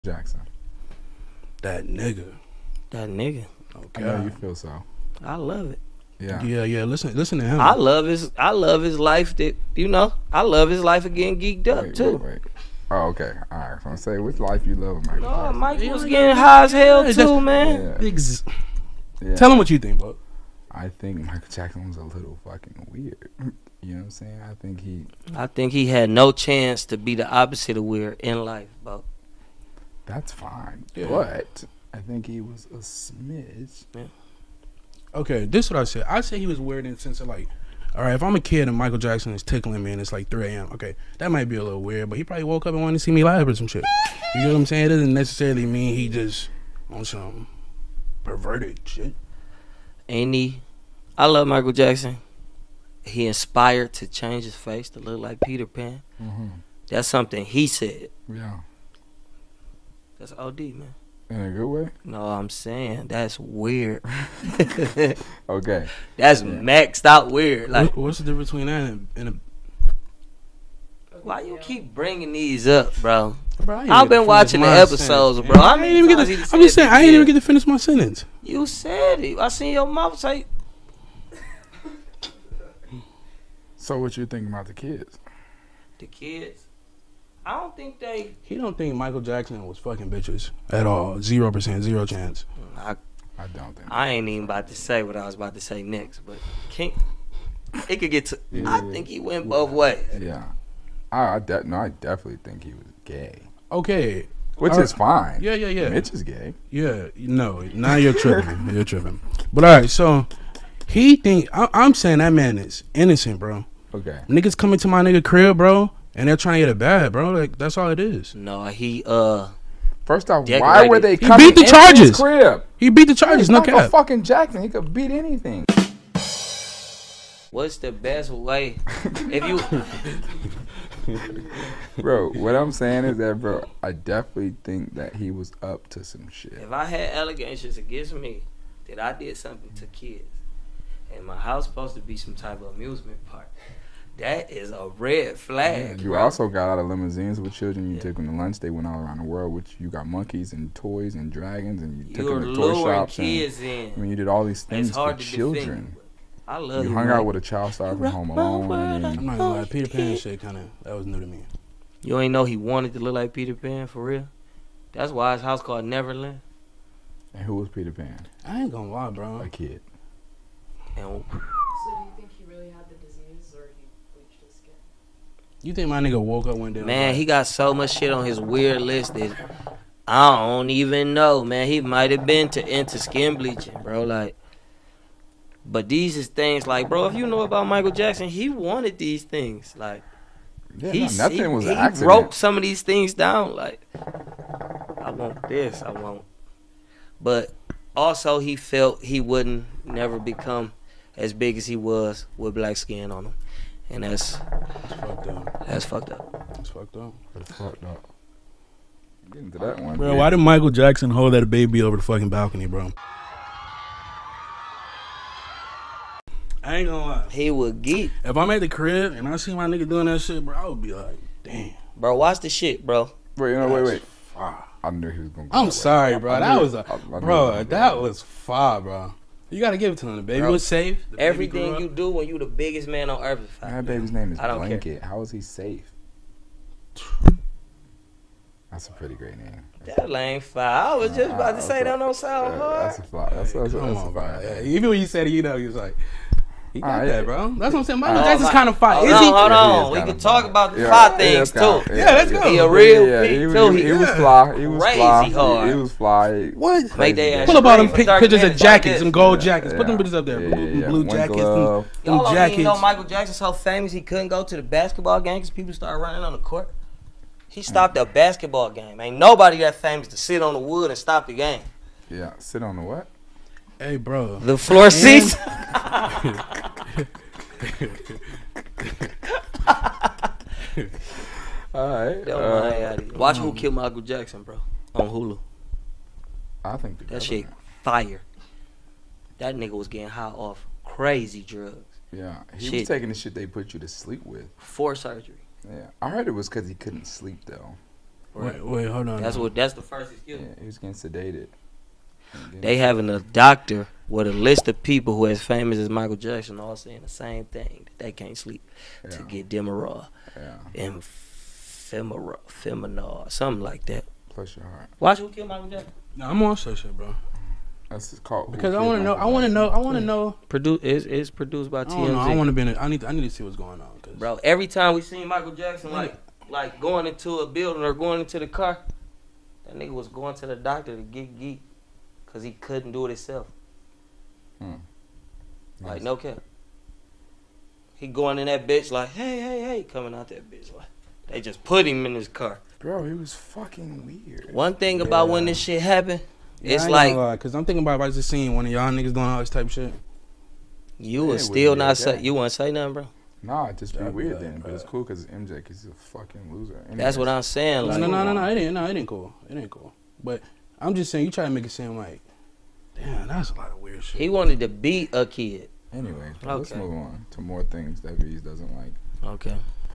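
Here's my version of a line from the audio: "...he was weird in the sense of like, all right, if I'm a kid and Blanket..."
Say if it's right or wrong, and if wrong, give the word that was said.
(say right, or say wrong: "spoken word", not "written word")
wrong: "Michael", not "Blanket".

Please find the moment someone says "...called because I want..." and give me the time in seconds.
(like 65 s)
318 s.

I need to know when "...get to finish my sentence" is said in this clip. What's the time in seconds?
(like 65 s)
77 s.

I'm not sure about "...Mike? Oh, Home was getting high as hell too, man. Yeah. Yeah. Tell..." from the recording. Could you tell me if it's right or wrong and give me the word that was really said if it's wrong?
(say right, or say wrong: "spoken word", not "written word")
wrong: "Mike", not "Home".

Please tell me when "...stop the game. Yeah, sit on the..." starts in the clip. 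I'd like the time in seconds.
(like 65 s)
270 s.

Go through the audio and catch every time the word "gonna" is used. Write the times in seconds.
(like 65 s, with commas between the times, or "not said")
159 s, 168 s, 216 s, 225 s.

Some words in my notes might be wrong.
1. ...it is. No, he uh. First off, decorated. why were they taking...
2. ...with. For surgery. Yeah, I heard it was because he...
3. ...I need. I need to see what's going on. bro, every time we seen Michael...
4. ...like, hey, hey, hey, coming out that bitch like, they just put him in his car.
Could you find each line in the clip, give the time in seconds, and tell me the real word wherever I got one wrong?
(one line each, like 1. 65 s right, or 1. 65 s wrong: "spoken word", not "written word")
1. 117 s wrong: "coming", not "taking"
2. 294 s right
3. 322 s right
4. 338 s right.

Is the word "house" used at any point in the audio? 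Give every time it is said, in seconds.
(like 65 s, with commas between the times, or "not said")
141 s, 165 s.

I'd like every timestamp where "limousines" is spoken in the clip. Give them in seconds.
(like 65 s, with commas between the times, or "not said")
146 s.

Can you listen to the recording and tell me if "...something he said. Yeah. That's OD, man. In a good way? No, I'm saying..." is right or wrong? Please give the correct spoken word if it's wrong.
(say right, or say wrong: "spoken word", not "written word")
right.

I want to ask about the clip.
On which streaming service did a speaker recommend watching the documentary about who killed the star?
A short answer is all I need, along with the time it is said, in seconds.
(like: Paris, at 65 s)
Hulu, at 285 s.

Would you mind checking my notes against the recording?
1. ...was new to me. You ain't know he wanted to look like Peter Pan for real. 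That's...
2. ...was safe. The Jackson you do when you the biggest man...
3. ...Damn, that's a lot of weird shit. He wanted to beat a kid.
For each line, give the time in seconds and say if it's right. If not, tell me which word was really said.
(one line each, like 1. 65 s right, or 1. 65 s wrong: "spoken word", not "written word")
1. 160 s right
2. 230 s wrong: "Everything", not "Jackson"
3. 362 s right.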